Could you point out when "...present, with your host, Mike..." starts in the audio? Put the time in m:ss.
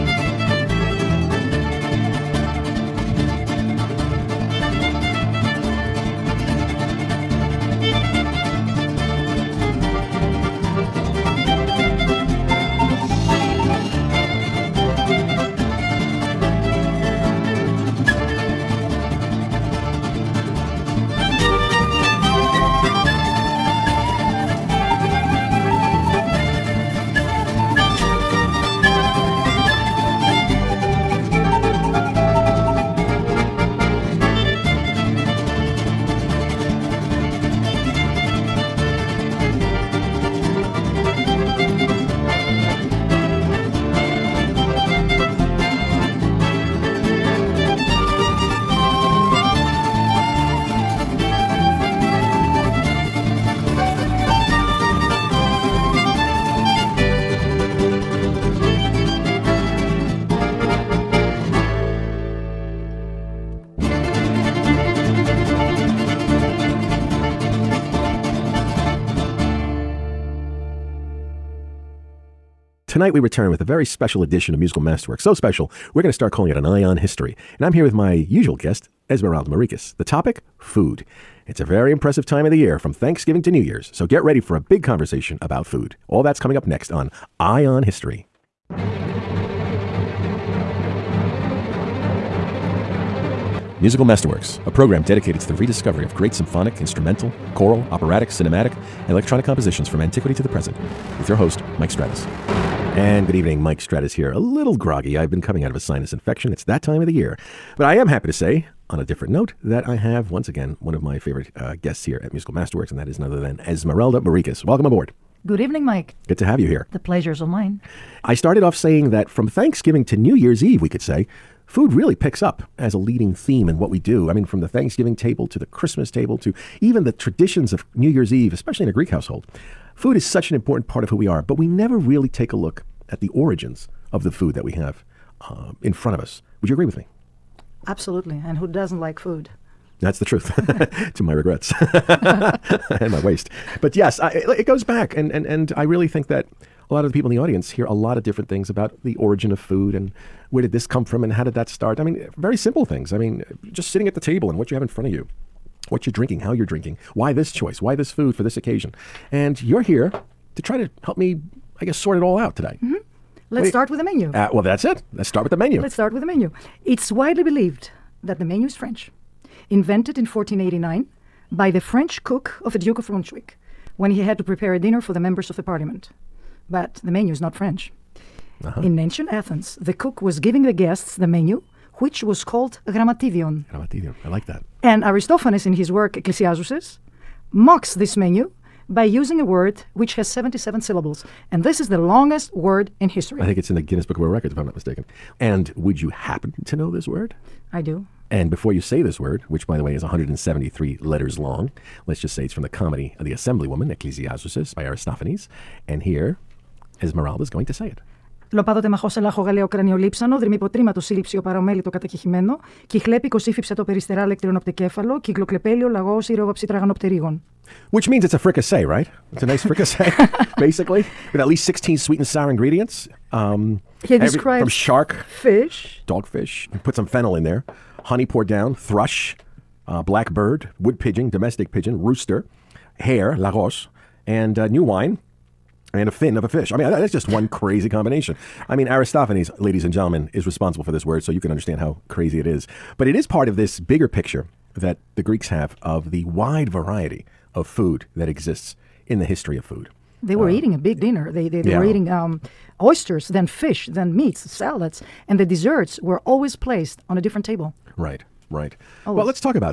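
1:40.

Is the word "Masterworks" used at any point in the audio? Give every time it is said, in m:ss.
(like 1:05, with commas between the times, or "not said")
1:14, 1:34, 1:52.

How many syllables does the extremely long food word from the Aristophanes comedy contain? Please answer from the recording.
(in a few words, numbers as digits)
77.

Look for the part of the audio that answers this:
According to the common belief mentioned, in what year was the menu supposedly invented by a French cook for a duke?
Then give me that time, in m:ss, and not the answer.
2:50.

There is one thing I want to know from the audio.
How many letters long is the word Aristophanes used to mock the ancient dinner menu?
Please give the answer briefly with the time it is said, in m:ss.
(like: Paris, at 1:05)
173, at 3:20.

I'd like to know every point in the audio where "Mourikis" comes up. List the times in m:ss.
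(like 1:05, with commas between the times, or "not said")
1:19, 1:54.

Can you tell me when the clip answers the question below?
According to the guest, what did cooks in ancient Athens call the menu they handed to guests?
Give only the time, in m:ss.
3:02.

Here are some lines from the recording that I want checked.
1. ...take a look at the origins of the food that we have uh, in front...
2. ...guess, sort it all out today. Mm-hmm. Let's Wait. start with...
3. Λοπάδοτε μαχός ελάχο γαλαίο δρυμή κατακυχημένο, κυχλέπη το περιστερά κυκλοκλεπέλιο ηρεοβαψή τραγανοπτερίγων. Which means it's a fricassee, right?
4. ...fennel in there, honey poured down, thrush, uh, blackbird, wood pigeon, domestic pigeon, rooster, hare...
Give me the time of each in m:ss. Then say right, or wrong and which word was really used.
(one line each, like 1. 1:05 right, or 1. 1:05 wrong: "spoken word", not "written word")
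1. 2:12 right
2. 2:41 right
3. 3:28 right
4. 3:47 right.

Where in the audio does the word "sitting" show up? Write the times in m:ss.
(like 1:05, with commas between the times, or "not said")
2:33.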